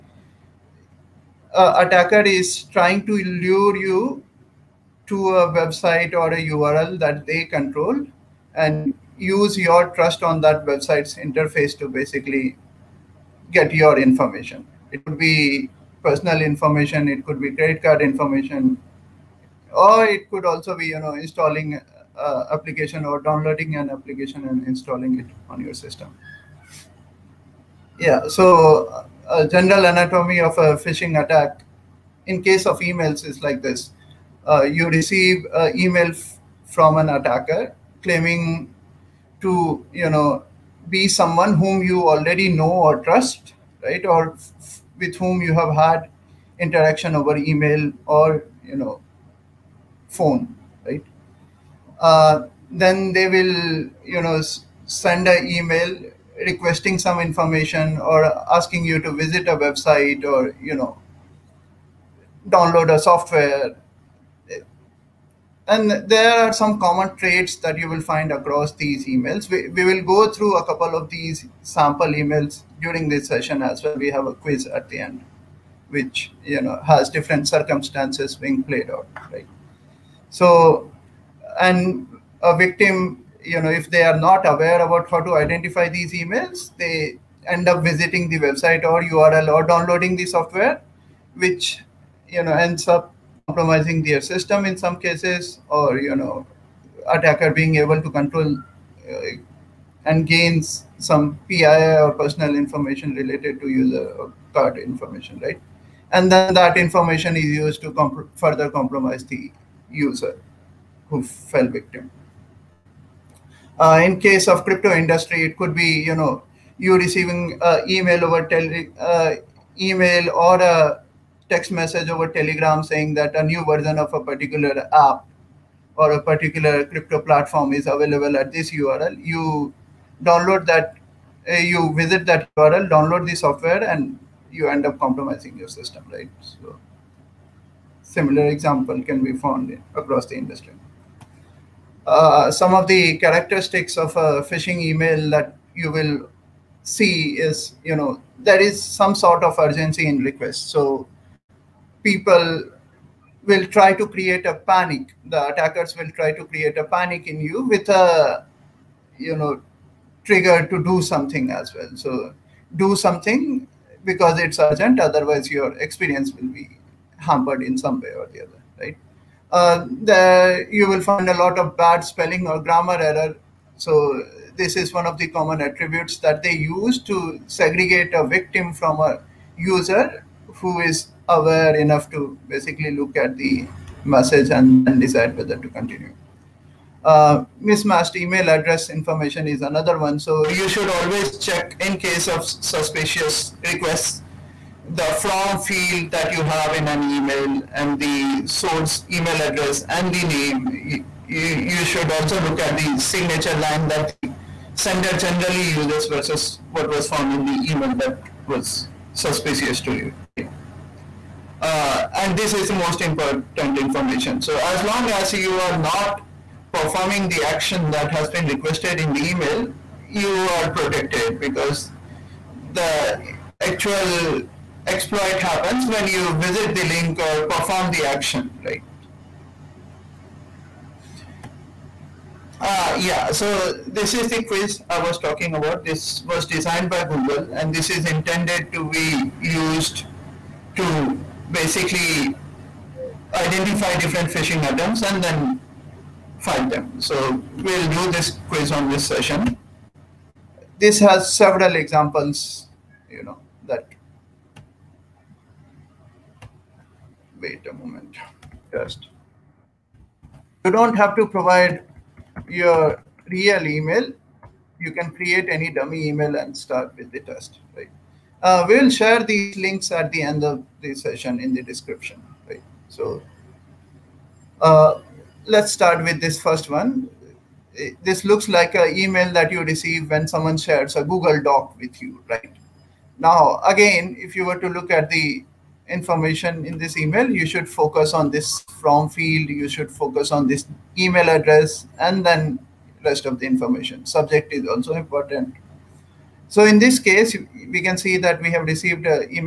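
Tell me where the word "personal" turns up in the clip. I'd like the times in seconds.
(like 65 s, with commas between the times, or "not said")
16 s, 102 s.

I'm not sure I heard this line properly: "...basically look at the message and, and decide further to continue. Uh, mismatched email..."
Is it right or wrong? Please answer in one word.
wrong.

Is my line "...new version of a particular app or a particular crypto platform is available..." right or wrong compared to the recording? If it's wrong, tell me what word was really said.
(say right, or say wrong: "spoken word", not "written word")
right.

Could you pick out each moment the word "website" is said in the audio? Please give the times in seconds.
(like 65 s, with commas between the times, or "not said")
5 s, 10 s, 59 s, 88 s.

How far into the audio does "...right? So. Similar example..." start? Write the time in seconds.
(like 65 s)
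136 s.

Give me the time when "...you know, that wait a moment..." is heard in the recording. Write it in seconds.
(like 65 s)
253 s.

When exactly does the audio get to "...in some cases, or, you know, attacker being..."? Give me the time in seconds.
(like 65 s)
94 s.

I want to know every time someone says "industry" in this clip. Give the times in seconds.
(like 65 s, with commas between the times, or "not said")
114 s, 140 s.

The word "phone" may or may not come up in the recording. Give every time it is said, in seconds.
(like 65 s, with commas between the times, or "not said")
50 s.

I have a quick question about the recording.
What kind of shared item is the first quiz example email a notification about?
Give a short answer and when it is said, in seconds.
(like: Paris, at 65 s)
A Google Doc, at 281 s.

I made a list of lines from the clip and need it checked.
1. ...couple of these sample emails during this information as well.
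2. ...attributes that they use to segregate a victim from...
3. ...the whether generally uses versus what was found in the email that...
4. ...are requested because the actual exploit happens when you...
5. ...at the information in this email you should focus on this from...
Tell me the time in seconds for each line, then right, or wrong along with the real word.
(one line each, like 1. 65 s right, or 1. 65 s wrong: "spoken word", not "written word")
1. 70 s wrong: "session", not "information"
2. 175 s right
3. 204 s wrong: "sender", not "whether"
4. 220 s wrong: "protected", not "requested"
5. 284 s right.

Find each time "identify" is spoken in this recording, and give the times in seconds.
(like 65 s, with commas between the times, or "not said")
85 s, 243 s.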